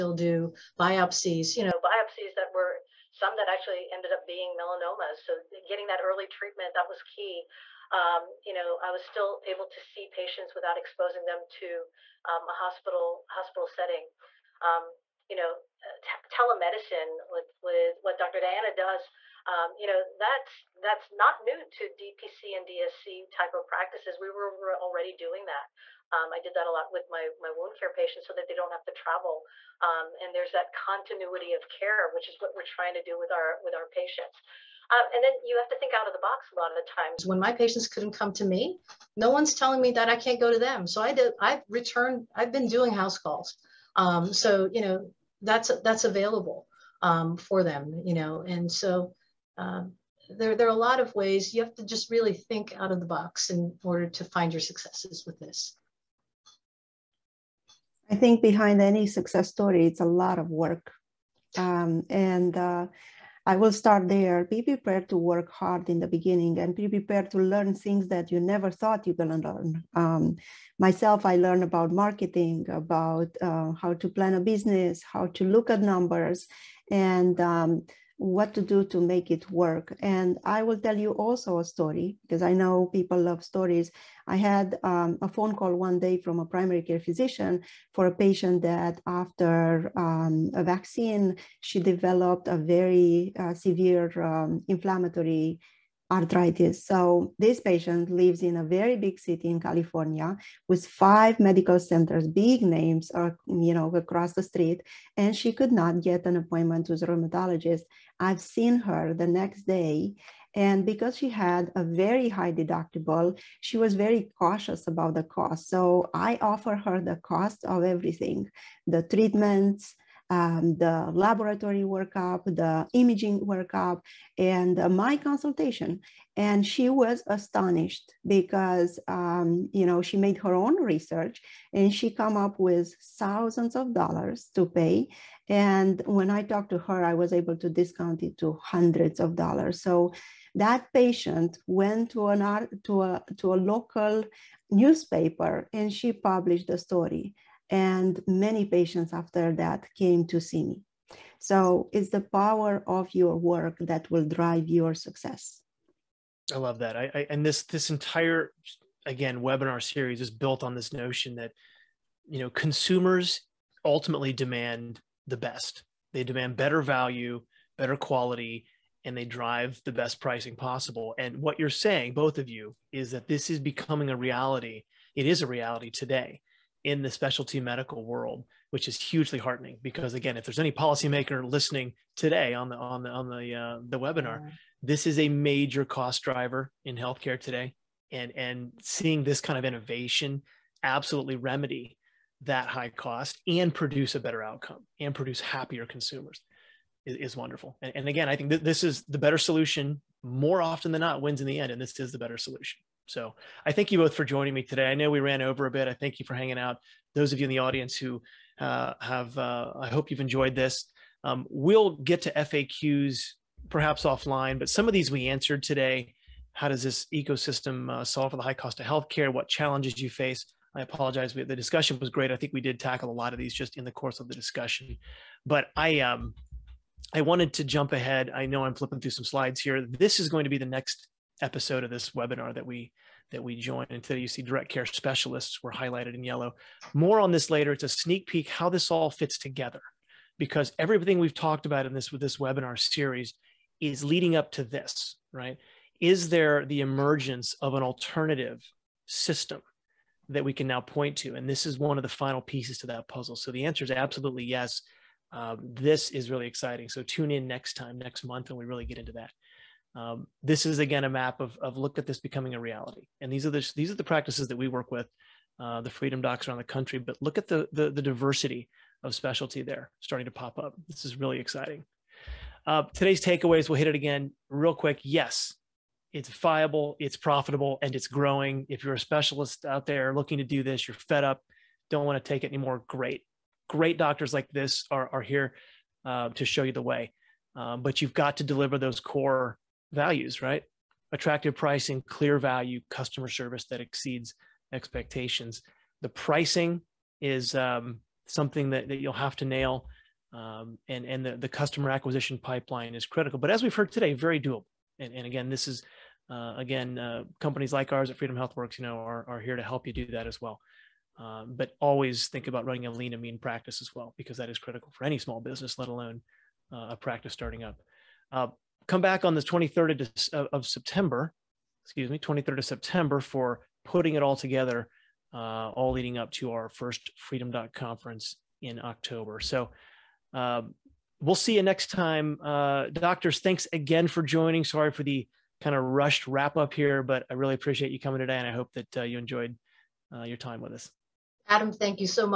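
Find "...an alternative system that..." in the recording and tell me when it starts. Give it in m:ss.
4:07.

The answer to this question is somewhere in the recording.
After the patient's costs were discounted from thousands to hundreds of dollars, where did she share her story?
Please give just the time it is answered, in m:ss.
2:23.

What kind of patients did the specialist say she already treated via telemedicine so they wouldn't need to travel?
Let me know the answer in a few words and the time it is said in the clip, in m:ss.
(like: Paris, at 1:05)
Wound care patients, at 0:27.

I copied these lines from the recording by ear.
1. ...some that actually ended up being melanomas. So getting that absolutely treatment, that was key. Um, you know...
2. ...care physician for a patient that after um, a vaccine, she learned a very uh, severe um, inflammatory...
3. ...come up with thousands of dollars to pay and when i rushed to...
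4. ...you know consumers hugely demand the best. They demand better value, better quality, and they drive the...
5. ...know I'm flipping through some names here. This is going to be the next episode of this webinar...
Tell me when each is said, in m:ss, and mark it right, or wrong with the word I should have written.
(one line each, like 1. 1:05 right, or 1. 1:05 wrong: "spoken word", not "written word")
1. 0:03 wrong: "early", not "absolutely"
2. 1:26 wrong: "developed", not "learned"
3. 2:12 wrong: "talked", not "rushed"
4. 2:42 wrong: "ultimately", not "hugely"
5. 3:48 wrong: "slides", not "names".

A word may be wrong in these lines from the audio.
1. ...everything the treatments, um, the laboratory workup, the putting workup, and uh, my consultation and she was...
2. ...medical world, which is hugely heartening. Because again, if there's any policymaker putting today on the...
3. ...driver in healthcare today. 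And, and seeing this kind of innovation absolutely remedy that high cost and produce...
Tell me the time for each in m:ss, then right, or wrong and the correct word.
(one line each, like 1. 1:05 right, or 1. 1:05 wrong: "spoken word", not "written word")
1. 1:57 wrong: "imaging", not "putting"
2. 2:57 wrong: "listening", not "putting"
3. 3:06 right.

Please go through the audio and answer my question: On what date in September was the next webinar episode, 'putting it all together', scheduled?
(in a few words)
September 23.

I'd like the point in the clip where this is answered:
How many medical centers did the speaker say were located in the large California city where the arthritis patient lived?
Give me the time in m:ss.
1:40.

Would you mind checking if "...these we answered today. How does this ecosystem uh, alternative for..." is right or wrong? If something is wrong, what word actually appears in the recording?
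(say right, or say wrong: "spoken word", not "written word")
wrong: "solve", not "alternative".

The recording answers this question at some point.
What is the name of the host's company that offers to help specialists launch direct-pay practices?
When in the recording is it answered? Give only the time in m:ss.
5:08.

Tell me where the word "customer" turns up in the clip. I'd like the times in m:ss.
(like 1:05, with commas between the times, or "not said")
4:52, 5:01.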